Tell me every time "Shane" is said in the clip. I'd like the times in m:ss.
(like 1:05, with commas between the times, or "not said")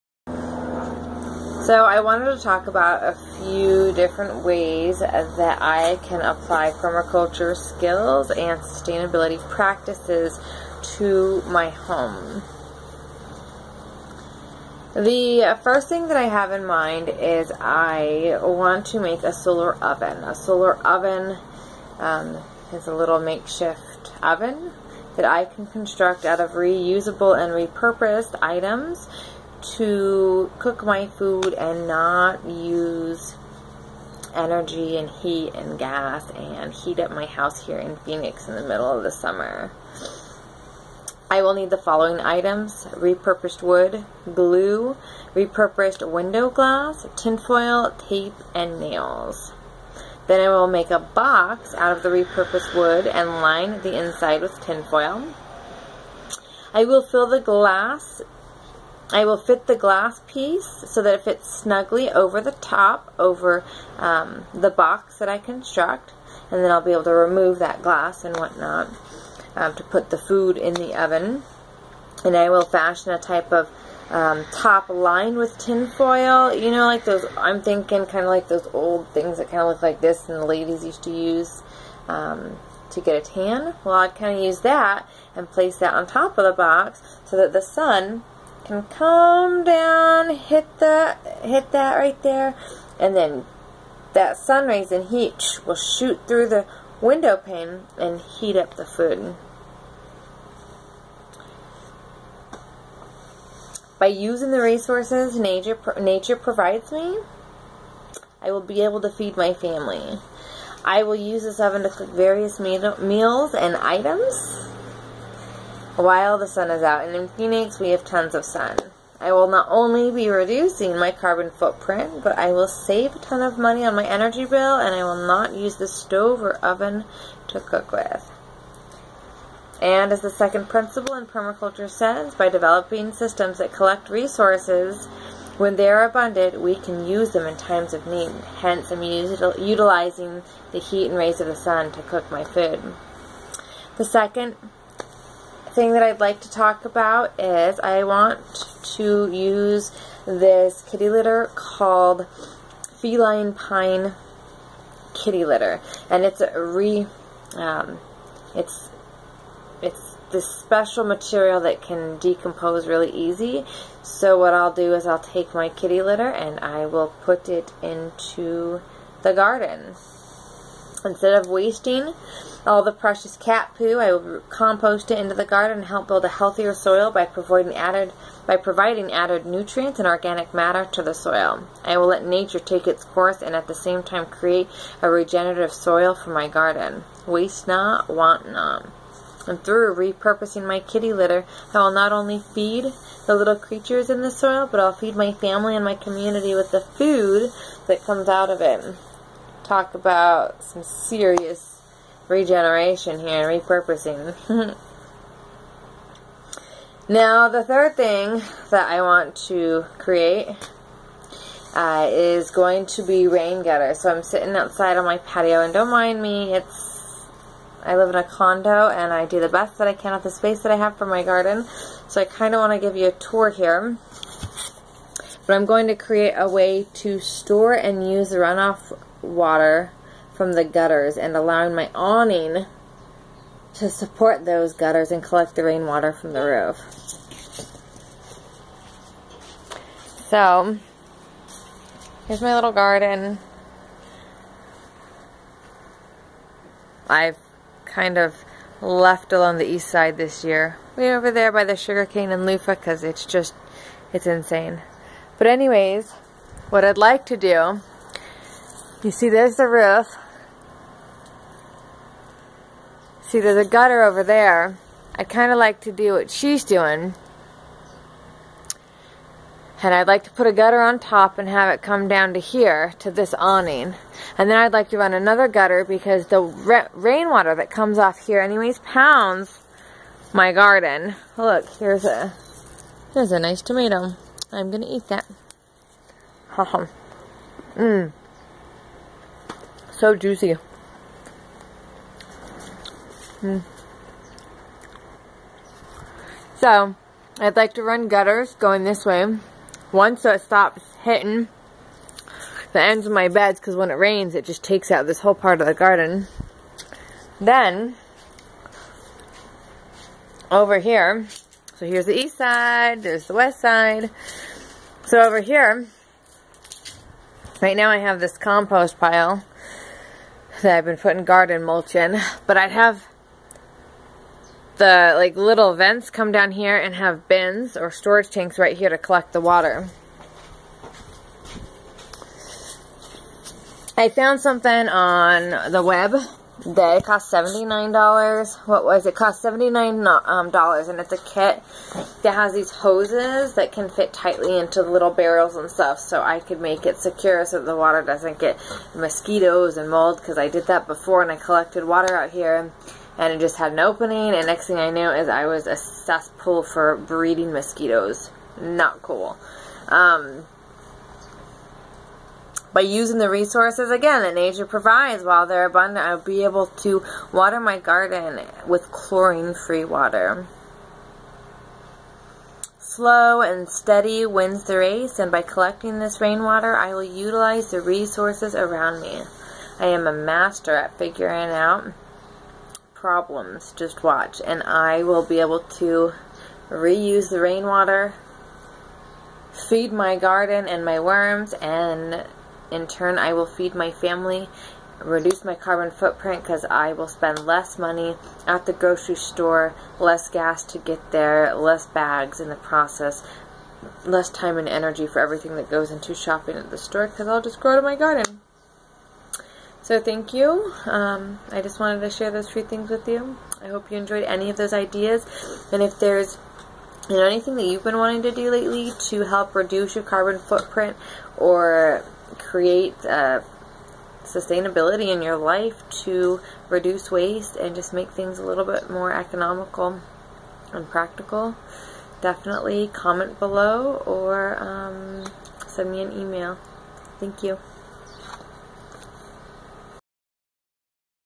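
not said.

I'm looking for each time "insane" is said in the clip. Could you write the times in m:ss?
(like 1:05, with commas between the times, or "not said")
4:14.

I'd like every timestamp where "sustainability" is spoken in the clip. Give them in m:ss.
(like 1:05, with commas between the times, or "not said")
0:08, 7:04.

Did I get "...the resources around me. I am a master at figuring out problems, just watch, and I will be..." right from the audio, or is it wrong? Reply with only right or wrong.
right.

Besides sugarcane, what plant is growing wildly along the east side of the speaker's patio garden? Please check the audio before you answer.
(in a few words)
Loofah.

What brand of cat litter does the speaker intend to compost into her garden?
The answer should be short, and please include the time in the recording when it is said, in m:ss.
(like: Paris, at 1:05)
Feline Pine, at 2:33.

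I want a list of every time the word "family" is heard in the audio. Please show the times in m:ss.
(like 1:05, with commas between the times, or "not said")
1:49, 3:15, 6:33.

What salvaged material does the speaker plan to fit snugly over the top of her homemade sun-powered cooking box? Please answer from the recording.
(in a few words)
Window glass.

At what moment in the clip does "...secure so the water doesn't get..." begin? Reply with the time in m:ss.
5:46.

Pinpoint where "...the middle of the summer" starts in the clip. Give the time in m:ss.
0:38.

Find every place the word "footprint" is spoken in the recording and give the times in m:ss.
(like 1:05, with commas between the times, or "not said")
2:01, 6:35, 7:00.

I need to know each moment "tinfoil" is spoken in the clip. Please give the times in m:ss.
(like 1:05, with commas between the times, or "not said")
0:47, 0:54.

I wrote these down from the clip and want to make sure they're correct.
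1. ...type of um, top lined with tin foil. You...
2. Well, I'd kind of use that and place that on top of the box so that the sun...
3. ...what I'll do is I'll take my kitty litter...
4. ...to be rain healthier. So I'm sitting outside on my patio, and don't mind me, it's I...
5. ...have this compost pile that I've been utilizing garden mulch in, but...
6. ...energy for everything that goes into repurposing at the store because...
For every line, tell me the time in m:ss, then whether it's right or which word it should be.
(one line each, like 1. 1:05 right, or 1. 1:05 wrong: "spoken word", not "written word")
1. 1:13 right
2. 1:23 right
3. 2:44 right
4. 3:32 wrong: "gutter", not "healthier"
5. 5:17 wrong: "putting", not "utilizing"
6. 6:44 wrong: "shopping", not "repurposing".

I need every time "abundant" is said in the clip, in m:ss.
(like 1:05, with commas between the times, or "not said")
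2:16, 6:05.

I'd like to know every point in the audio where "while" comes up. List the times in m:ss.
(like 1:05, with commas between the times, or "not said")
1:55, 6:05.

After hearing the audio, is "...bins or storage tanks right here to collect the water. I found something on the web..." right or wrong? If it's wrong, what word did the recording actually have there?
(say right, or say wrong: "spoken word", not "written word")
right.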